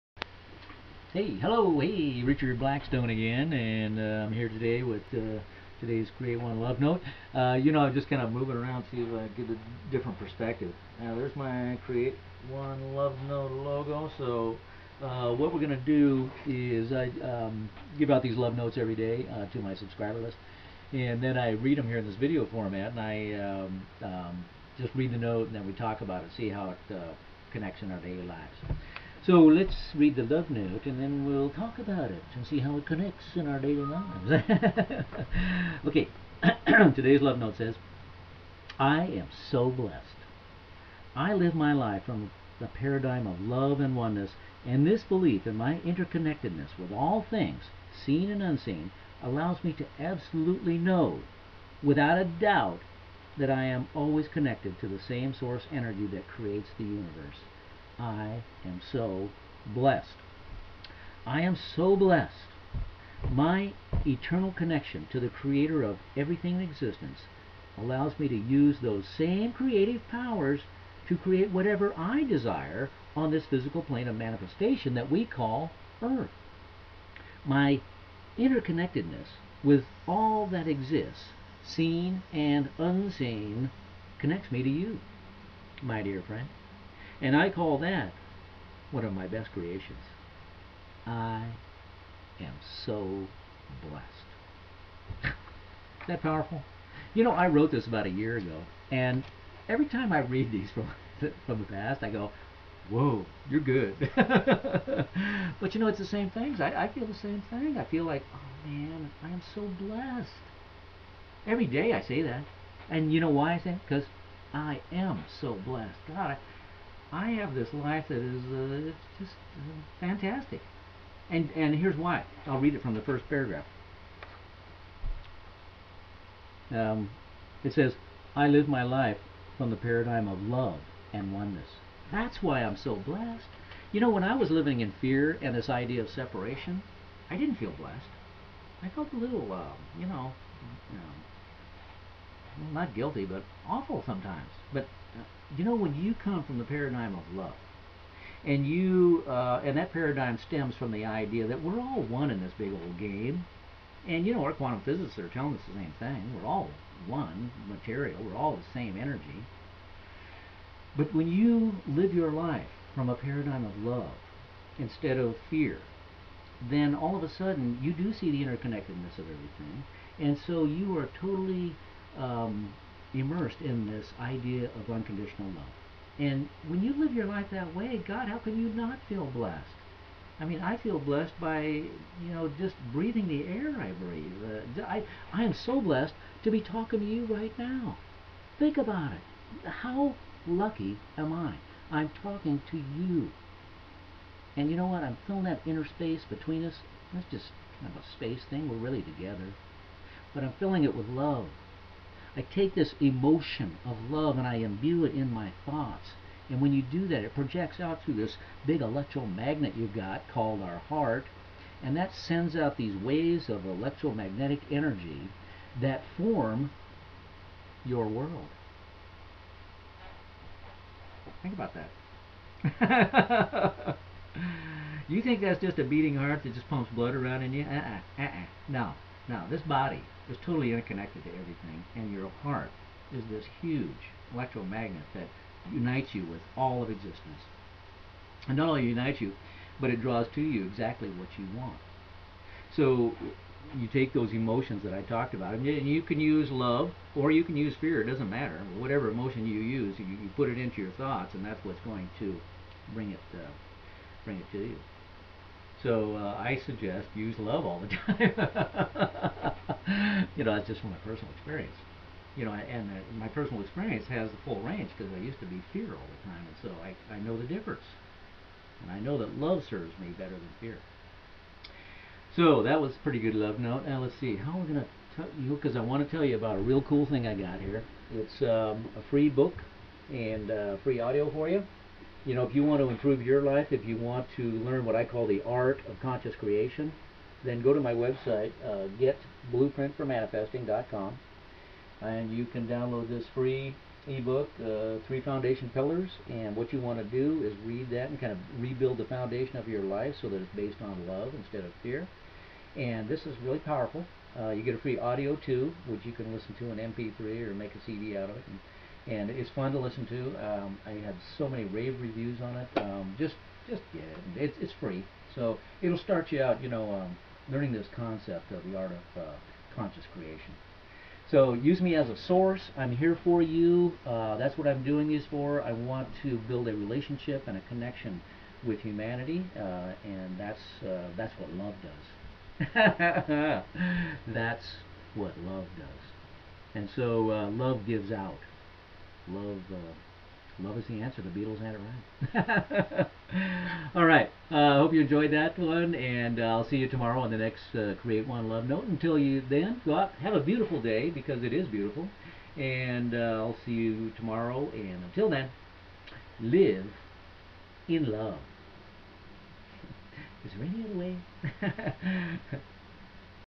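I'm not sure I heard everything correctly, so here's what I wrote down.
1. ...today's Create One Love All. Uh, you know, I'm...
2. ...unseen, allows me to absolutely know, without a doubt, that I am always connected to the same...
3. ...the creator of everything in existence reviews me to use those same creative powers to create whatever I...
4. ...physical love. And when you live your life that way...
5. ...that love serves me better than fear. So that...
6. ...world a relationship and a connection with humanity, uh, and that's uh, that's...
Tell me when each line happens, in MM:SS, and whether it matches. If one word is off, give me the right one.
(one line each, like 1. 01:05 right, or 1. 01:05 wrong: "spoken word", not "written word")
1. 00:05 wrong: "Note", not "All"
2. 00:48 right
3. 01:05 wrong: "allows", not "reviews"
4. 02:54 wrong: "unconditional", not "physical"
5. 04:29 right
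6. 05:26 wrong: "build", not "world".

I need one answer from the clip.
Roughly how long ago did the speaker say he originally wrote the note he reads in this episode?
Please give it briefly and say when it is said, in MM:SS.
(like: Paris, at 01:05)
about a year ago, at 01:37.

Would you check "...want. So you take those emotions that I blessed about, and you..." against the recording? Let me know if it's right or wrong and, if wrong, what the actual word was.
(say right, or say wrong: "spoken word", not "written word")
wrong: "talked", not "blessed".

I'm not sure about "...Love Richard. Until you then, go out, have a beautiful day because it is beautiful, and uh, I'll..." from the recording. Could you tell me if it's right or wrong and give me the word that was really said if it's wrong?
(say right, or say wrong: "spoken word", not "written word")
wrong: "Note", not "Richard".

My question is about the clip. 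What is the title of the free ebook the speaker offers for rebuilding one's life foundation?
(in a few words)
Three Foundation Pillars.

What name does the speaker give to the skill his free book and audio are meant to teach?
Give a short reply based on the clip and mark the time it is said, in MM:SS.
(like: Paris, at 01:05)
the art of conscious creation, at 04:45.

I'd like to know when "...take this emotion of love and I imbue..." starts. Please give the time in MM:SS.
03:22.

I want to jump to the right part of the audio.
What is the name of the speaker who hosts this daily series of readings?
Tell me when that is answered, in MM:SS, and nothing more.
00:02.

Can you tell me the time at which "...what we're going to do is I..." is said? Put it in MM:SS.
00:15.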